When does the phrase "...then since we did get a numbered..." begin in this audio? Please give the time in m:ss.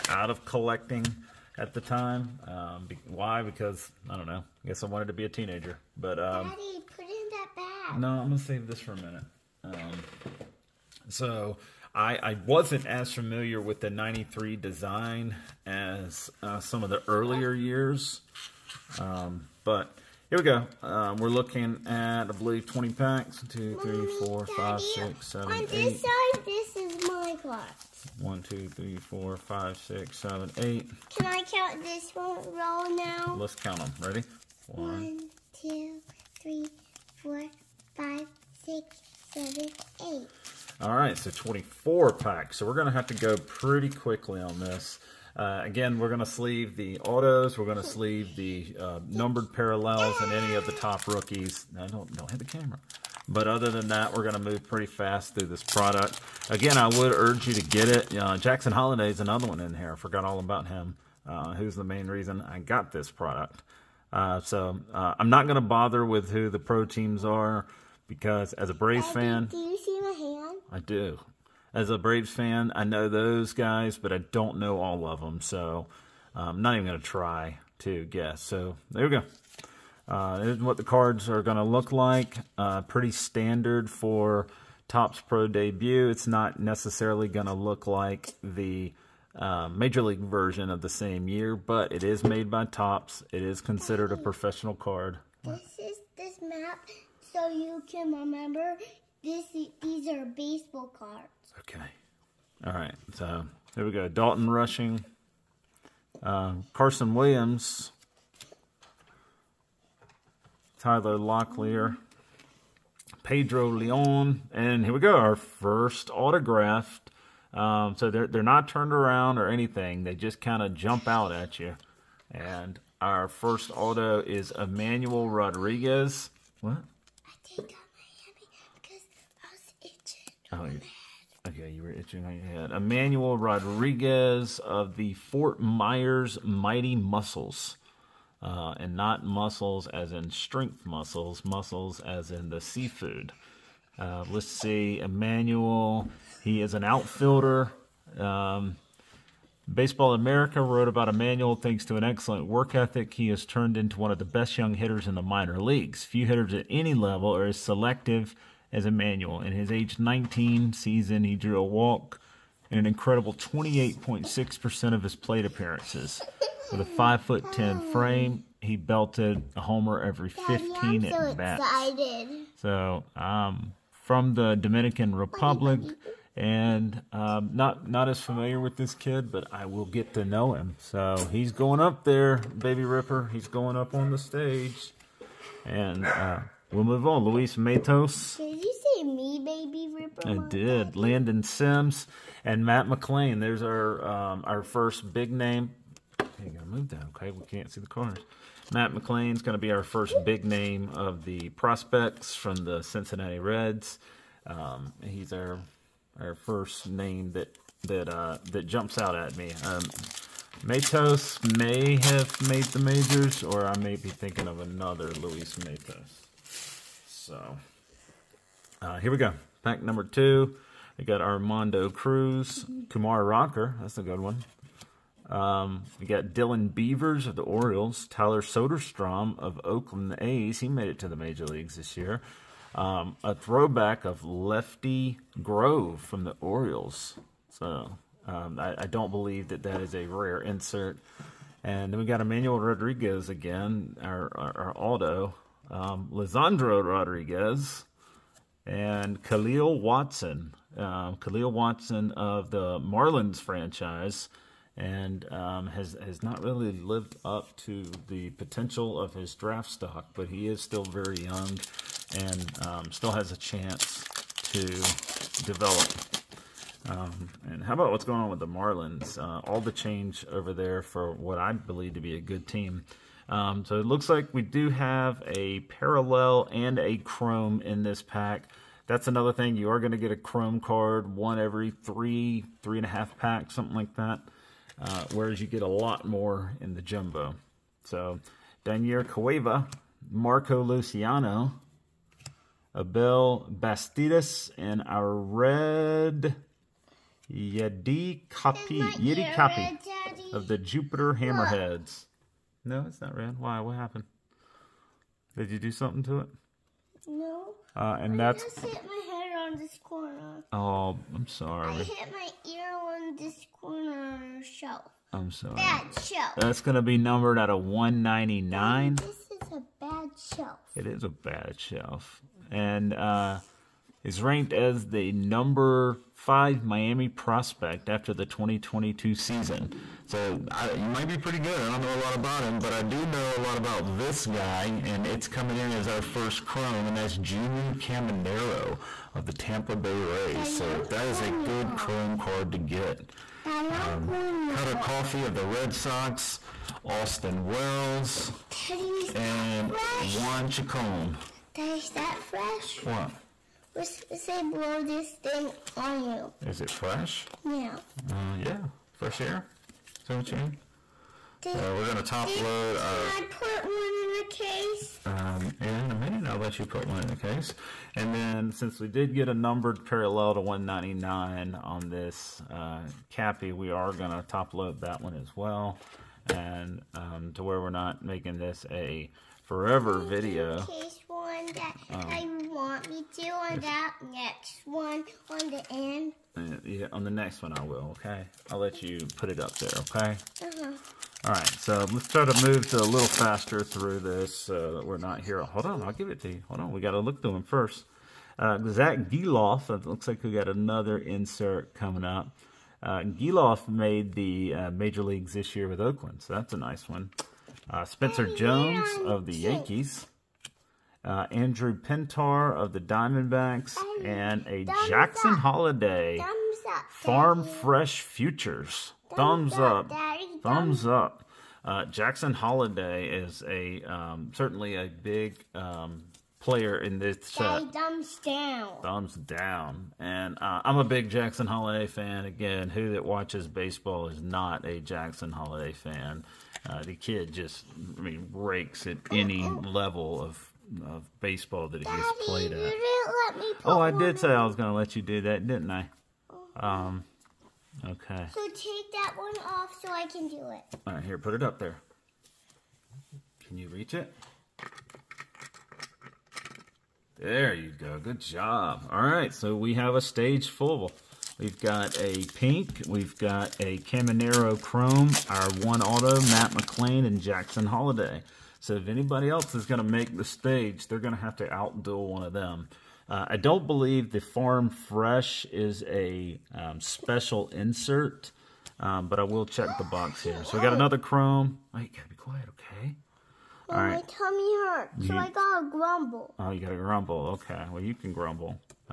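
6:08.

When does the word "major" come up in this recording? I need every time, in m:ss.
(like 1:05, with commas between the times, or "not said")
1:29, 3:32, 3:51, 6:44.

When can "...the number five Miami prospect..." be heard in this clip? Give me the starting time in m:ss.
5:24.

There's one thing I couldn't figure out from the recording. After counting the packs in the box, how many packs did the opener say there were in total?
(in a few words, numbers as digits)
24.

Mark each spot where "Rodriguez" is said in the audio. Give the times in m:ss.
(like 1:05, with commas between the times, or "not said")
2:05, 2:13, 4:02, 4:06.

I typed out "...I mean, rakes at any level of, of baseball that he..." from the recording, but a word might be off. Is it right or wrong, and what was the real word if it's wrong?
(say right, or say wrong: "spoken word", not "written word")
right.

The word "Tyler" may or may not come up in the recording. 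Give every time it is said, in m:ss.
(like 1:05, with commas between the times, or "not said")
1:50, 3:48.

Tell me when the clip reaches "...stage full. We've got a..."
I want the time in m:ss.
7:40.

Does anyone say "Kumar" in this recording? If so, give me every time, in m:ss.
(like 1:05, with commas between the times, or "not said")
3:42.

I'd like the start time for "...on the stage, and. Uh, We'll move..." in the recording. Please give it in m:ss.
3:03.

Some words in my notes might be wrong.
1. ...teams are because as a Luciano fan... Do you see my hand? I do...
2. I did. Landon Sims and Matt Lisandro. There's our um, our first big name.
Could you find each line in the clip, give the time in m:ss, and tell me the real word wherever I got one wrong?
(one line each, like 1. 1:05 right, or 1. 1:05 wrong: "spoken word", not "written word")
1. 1:06 wrong: "Braves", not "Luciano"
2. 3:10 wrong: "McLain", not "Lisandro".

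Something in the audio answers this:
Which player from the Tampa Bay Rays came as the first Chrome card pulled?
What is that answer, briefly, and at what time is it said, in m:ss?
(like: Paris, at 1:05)
Junior Caminero, at 5:37.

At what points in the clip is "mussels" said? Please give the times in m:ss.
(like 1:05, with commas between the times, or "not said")
2:16, 2:21.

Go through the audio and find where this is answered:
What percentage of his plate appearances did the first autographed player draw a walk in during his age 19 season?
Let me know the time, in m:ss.
2:43.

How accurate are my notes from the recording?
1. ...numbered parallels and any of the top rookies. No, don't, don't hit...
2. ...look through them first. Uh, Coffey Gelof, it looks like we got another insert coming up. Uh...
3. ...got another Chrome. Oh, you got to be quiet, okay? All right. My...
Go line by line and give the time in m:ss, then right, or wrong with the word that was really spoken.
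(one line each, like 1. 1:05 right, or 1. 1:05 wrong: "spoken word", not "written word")
1. 0:49 right
2. 6:36 wrong: "Zack", not "Coffey"
3. 8:00 right.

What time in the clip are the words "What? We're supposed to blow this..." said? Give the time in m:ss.
5:52.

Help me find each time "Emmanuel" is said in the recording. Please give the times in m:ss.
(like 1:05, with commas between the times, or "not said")
2:04, 2:12, 2:25, 2:31, 2:38, 4:02.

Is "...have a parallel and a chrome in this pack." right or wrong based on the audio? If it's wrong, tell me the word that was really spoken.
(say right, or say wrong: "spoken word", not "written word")
right.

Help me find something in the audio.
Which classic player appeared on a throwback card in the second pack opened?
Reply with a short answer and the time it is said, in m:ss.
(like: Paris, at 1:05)
Lefty Grove, at 3:54.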